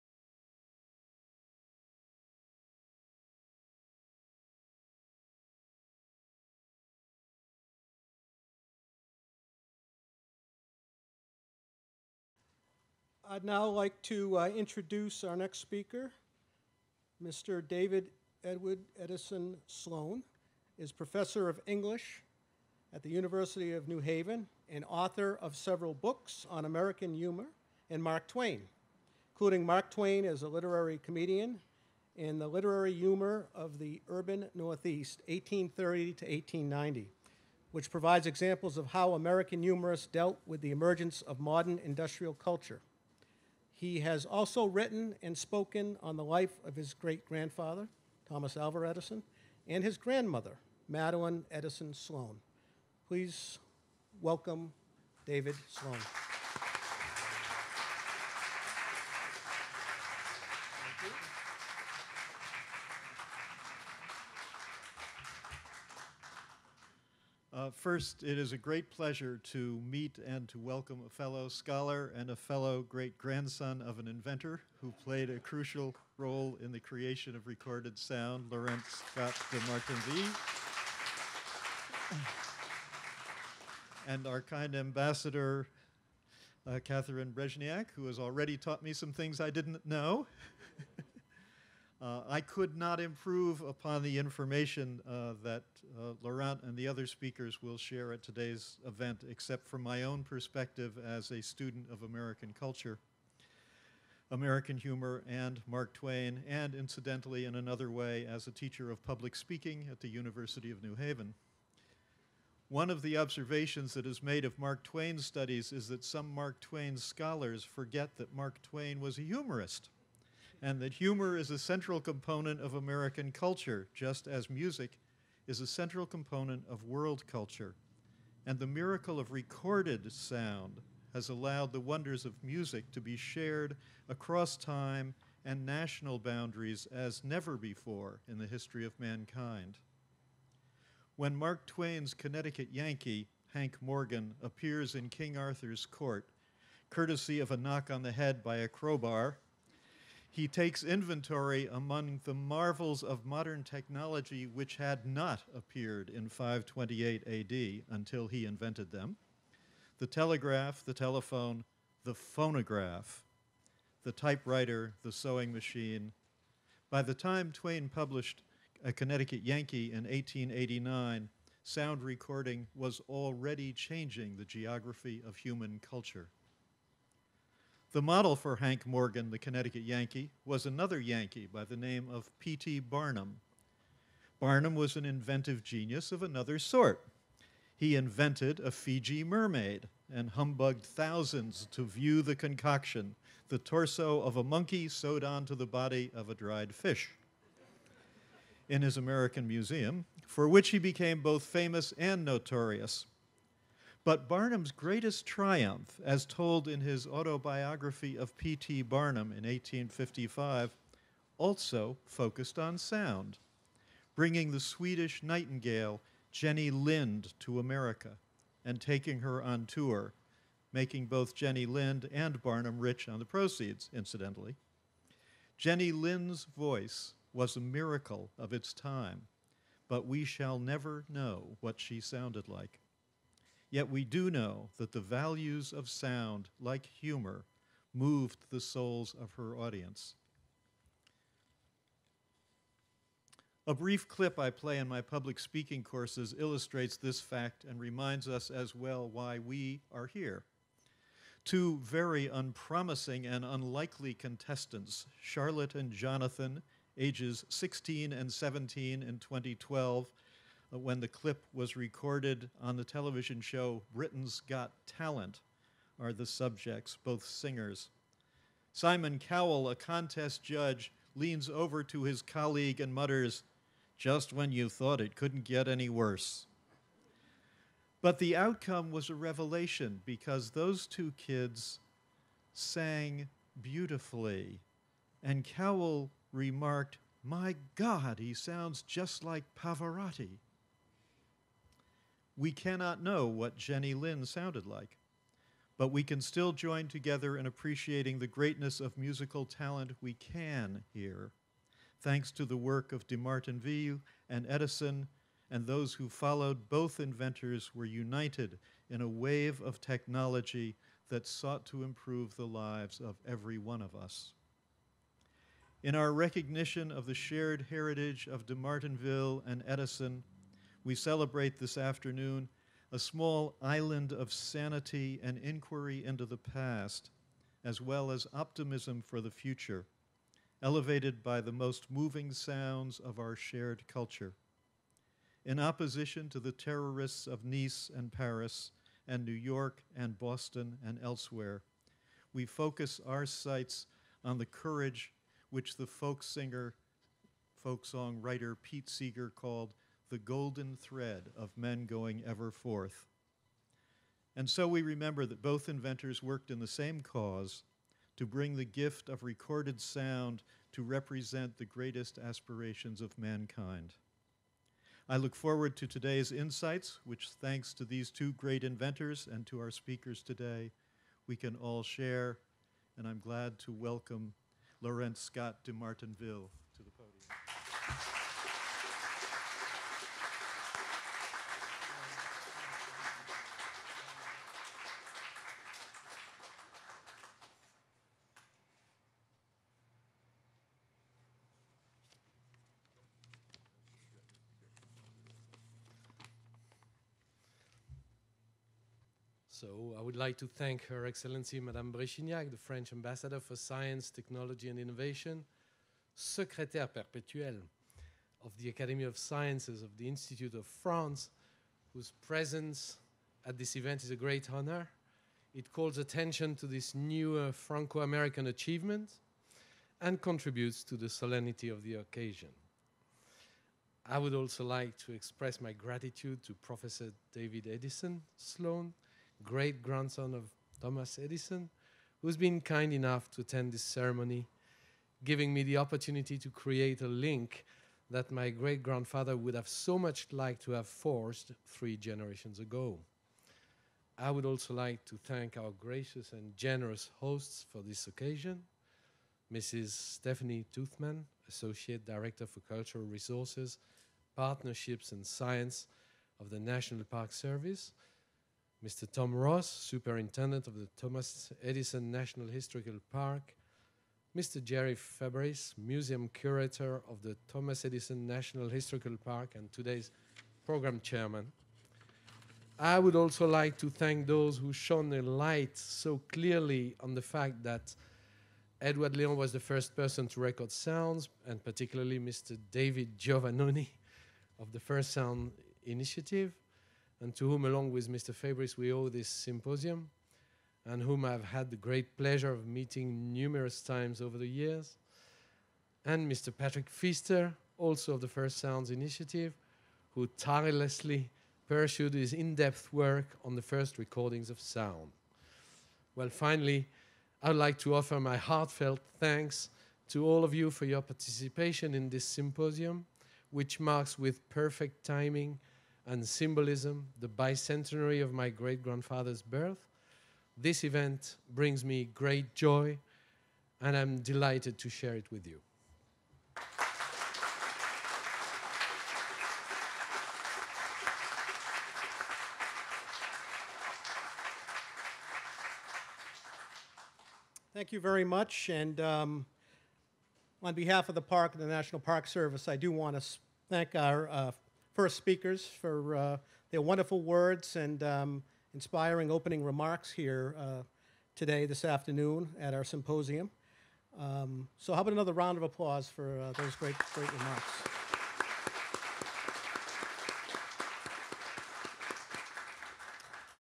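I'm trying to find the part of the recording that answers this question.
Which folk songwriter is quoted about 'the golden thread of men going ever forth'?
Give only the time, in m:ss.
5:48.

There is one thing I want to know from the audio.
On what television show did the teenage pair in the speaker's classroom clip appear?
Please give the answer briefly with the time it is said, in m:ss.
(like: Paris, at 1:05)
Britain's Got Talent, at 4:23.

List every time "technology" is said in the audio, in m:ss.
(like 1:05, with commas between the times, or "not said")
2:33, 5:09, 6:44.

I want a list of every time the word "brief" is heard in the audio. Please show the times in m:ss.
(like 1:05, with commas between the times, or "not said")
4:03.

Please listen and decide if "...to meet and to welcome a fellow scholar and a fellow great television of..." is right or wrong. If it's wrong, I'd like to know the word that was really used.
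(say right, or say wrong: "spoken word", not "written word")
wrong: "grandson", not "television".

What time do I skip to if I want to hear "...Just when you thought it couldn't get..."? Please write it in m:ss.
4:33.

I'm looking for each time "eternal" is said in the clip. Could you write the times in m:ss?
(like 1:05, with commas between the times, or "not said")
not said.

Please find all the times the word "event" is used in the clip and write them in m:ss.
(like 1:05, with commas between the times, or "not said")
1:38, 6:53, 8:40.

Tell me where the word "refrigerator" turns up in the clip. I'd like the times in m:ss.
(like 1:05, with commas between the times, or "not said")
not said.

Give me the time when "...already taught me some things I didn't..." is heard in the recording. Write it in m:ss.
1:28.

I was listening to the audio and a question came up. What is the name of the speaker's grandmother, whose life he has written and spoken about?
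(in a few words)
Madeleine Edison Sloane.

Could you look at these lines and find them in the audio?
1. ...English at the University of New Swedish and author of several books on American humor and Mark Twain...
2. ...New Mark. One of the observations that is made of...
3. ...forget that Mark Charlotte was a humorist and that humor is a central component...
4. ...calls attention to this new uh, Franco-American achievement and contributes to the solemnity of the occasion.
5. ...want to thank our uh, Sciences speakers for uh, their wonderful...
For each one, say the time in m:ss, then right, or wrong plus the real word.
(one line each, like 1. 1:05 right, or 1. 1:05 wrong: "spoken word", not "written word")
1. 0:21 wrong: "Haven", not "Swedish"
2. 1:50 wrong: "Haven", not "Mark"
3. 1:57 wrong: "Twain", not "Charlotte"
4. 6:55 right
5. 9:02 wrong: "First", not "Sciences".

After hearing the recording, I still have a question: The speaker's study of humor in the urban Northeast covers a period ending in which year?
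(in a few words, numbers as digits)
1890.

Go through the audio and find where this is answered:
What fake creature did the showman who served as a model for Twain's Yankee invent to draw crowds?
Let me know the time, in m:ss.
3:08.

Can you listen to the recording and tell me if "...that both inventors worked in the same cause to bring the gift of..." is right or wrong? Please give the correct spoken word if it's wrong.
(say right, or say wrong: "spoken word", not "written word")
right.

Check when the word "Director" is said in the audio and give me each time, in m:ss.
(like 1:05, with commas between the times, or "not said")
7:32.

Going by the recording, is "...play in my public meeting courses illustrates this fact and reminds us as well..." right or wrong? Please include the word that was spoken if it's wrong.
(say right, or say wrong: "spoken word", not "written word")
wrong: "speaking", not "meeting".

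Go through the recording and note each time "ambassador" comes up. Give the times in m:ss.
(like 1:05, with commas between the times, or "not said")
1:24, 6:42.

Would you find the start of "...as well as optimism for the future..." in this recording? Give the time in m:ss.
5:27.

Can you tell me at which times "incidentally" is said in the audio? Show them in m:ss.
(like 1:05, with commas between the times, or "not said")
1:46, 3:43.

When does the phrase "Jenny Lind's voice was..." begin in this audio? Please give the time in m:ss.
3:45.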